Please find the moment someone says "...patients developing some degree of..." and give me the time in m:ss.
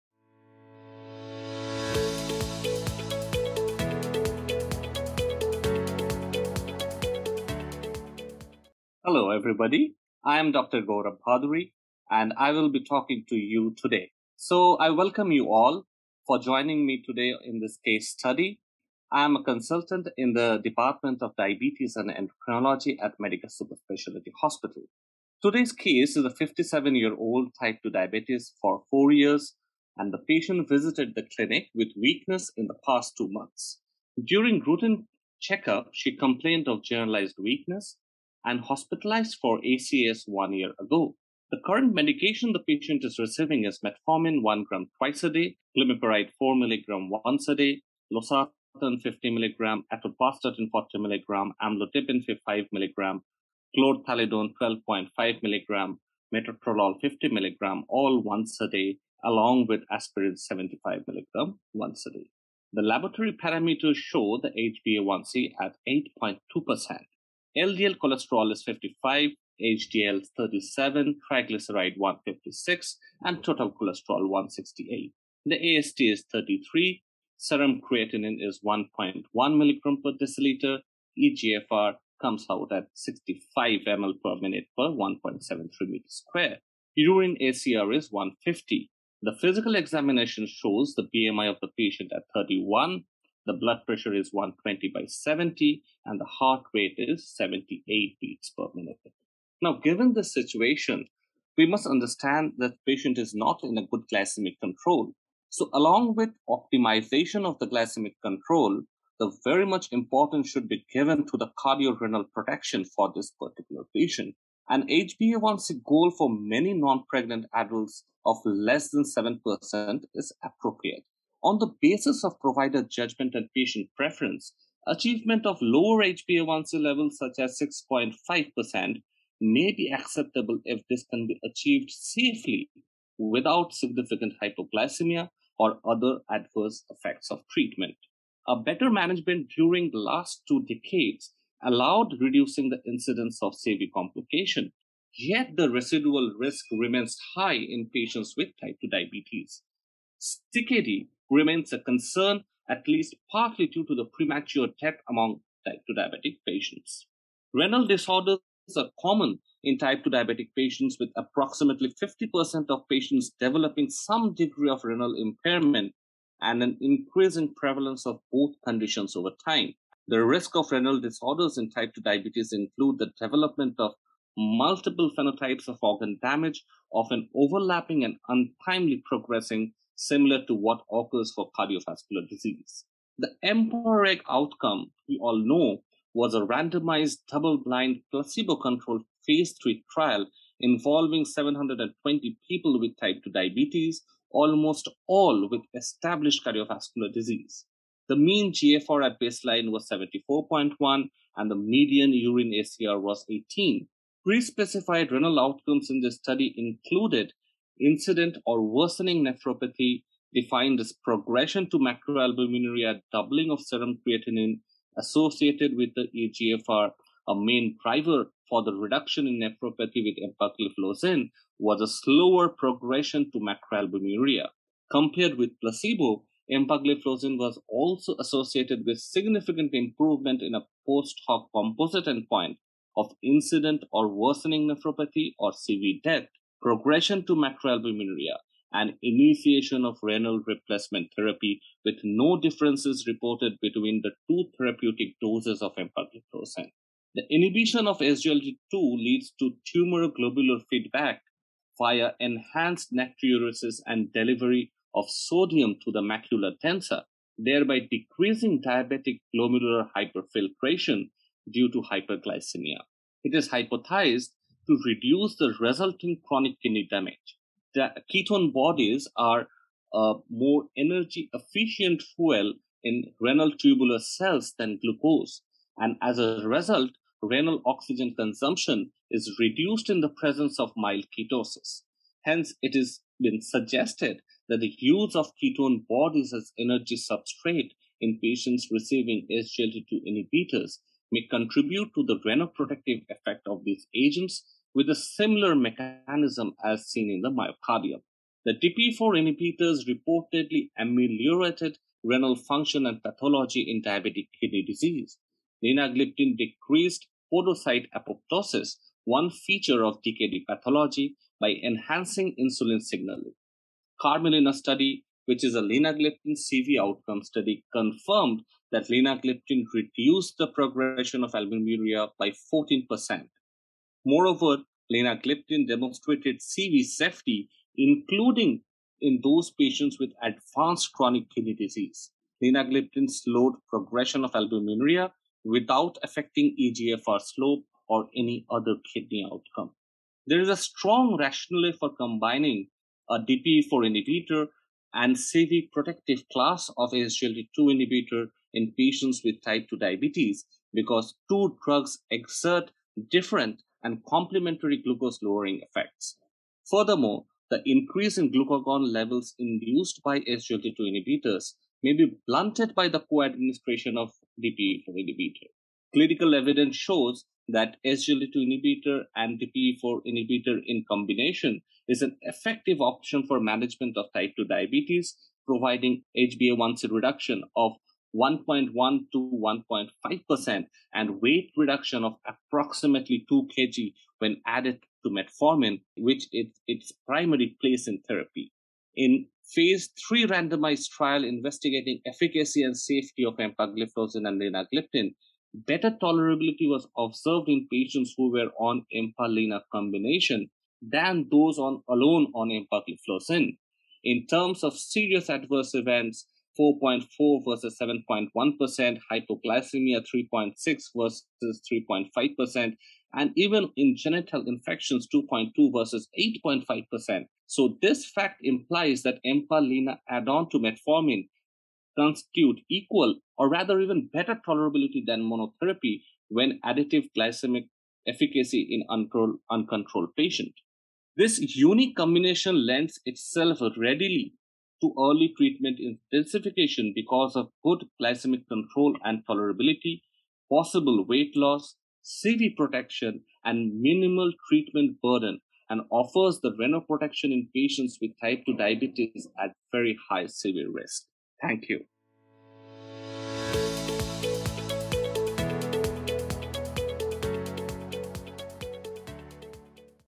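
2:42.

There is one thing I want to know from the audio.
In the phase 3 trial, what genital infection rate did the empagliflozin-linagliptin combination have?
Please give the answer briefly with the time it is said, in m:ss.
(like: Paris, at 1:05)
2.2%, at 6:55.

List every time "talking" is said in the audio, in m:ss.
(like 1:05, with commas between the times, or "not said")
0:12.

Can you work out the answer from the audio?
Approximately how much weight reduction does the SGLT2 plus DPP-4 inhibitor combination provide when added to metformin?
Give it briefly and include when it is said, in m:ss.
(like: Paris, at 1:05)
2 kg, at 6:23.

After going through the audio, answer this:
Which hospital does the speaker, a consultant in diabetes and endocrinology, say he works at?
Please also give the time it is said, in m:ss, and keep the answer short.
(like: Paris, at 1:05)
Medica Specialty Hospital, at 0:23.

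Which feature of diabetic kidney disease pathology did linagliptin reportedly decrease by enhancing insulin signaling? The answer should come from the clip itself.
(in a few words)
Podocyte apoptosis.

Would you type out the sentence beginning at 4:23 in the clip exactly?
It is hypothesized to reduce the resulting chronic kidney damage.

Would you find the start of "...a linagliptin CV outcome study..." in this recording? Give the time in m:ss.
5:15.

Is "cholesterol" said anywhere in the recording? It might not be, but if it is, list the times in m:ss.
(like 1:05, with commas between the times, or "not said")
1:07, 1:13.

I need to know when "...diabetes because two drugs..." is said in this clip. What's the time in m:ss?
5:49.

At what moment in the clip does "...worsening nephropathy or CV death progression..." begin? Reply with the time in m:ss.
3:54.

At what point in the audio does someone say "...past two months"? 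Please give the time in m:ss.
0:32.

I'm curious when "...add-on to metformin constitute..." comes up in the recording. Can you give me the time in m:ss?
7:00.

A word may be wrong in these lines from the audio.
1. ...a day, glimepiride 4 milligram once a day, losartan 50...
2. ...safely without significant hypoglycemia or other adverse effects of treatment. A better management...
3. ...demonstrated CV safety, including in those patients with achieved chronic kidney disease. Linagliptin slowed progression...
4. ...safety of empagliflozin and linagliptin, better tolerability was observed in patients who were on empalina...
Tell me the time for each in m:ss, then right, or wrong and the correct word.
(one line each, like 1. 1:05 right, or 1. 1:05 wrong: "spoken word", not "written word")
1. 0:45 right
2. 2:11 right
3. 5:25 wrong: "advanced", not "achieved"
4. 6:32 right.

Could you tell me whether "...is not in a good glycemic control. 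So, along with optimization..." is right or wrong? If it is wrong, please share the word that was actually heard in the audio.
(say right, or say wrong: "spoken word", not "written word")
right.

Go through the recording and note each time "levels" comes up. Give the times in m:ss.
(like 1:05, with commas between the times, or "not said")
2:06, 5:58.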